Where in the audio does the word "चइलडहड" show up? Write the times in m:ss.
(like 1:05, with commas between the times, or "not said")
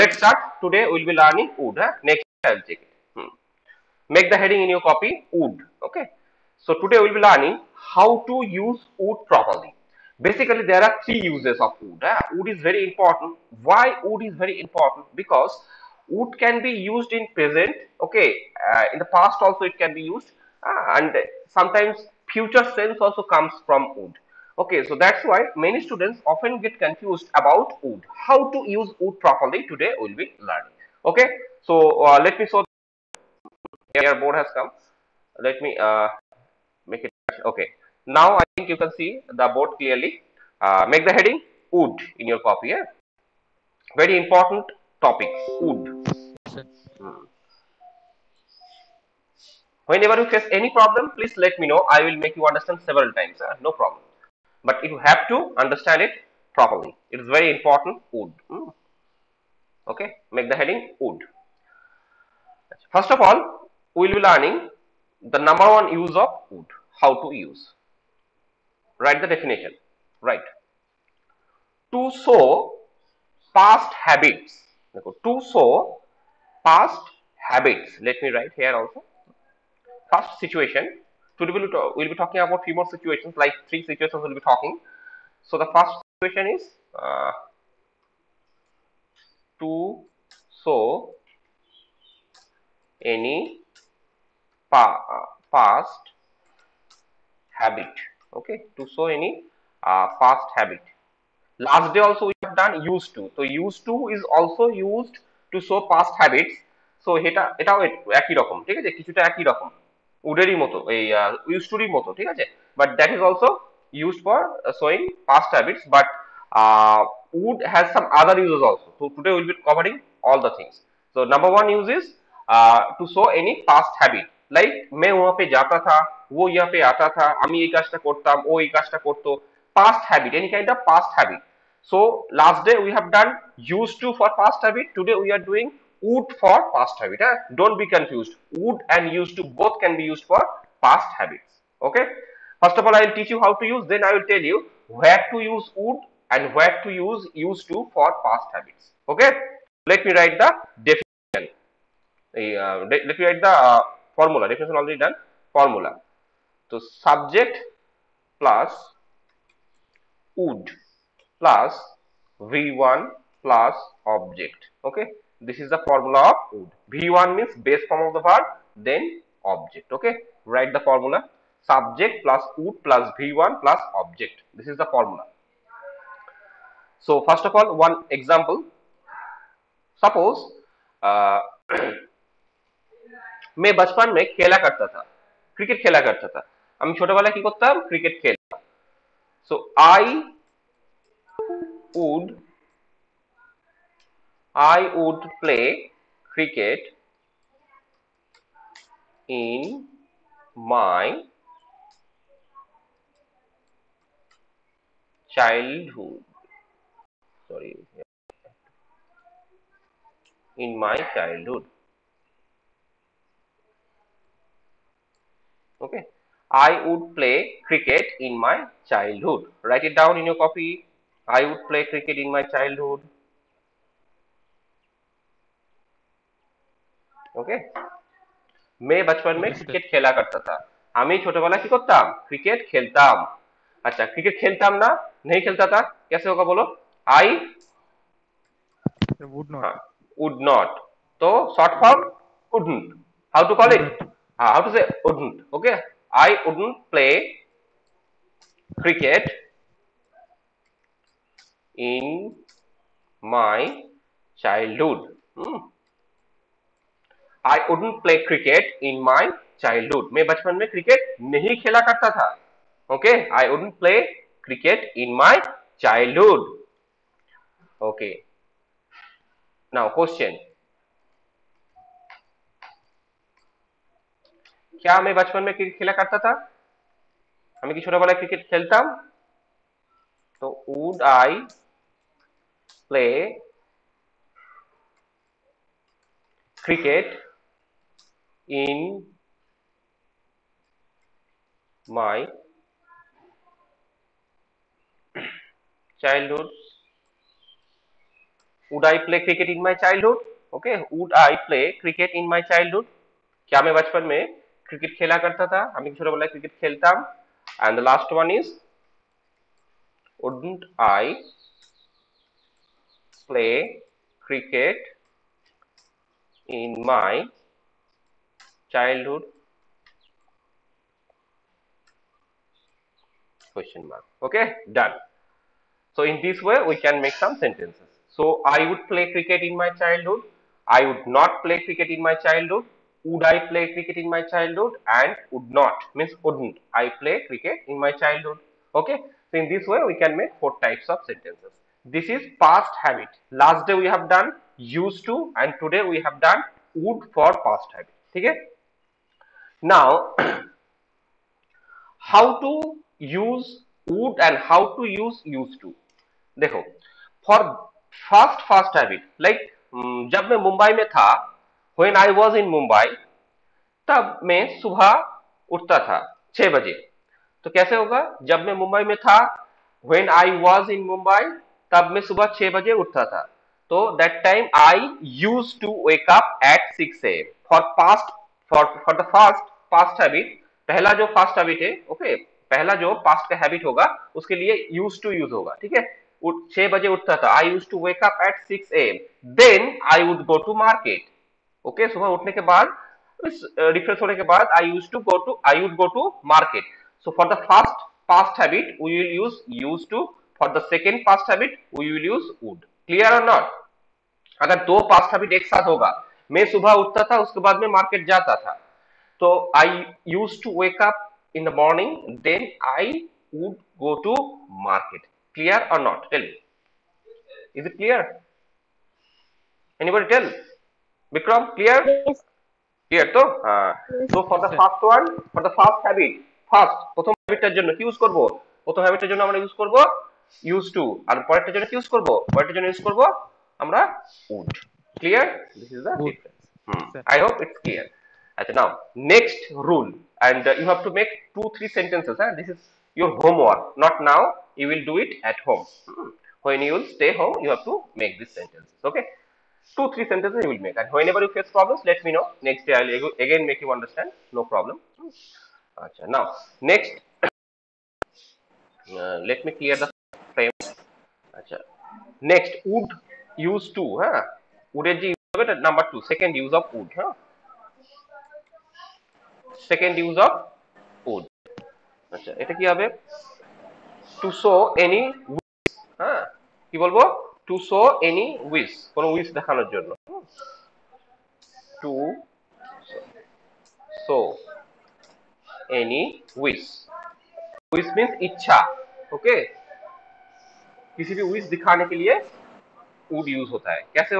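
4:14, 4:19, 4:25.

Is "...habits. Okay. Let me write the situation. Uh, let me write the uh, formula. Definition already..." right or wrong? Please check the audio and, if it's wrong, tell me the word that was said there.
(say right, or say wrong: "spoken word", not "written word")
wrong: "definition", not "situation".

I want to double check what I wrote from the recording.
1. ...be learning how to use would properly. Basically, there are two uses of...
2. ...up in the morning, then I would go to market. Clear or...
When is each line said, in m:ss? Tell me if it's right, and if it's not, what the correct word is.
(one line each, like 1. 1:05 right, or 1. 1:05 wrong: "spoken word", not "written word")
1. 0:07 wrong: "three", not "two"
2. 6:50 right.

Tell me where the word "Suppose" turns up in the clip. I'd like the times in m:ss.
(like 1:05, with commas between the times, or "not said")
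3:00.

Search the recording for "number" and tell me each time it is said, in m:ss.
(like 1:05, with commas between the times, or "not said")
1:05, 2:01, 7:45.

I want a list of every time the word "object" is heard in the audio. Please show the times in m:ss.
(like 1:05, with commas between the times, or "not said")
2:44, 2:49, 2:53.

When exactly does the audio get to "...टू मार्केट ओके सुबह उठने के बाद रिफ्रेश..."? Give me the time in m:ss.
6:30.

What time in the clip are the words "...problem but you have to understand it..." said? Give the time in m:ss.
0:53.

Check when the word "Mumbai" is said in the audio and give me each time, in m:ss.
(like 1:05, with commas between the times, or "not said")
6:02, 6:10.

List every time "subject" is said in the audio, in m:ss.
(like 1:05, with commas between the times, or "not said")
2:36, 2:51.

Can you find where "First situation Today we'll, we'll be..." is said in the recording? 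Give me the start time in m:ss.
1:20.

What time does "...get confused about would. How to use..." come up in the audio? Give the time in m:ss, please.
0:26.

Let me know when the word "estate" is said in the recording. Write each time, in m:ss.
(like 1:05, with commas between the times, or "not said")
not said.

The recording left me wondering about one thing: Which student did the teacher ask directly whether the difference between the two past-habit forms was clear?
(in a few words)
Vikram.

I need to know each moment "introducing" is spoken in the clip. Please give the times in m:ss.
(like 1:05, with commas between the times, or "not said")
not said.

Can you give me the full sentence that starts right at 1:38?
Okay, to show any uh, past habit.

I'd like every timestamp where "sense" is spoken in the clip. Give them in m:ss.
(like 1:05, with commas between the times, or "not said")
0:22.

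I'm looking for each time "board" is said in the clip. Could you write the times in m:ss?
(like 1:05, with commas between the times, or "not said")
0:34, 0:39.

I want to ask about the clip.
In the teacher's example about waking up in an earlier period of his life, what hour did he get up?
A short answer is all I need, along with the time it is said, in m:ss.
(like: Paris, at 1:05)
6 a.m., at 6:14.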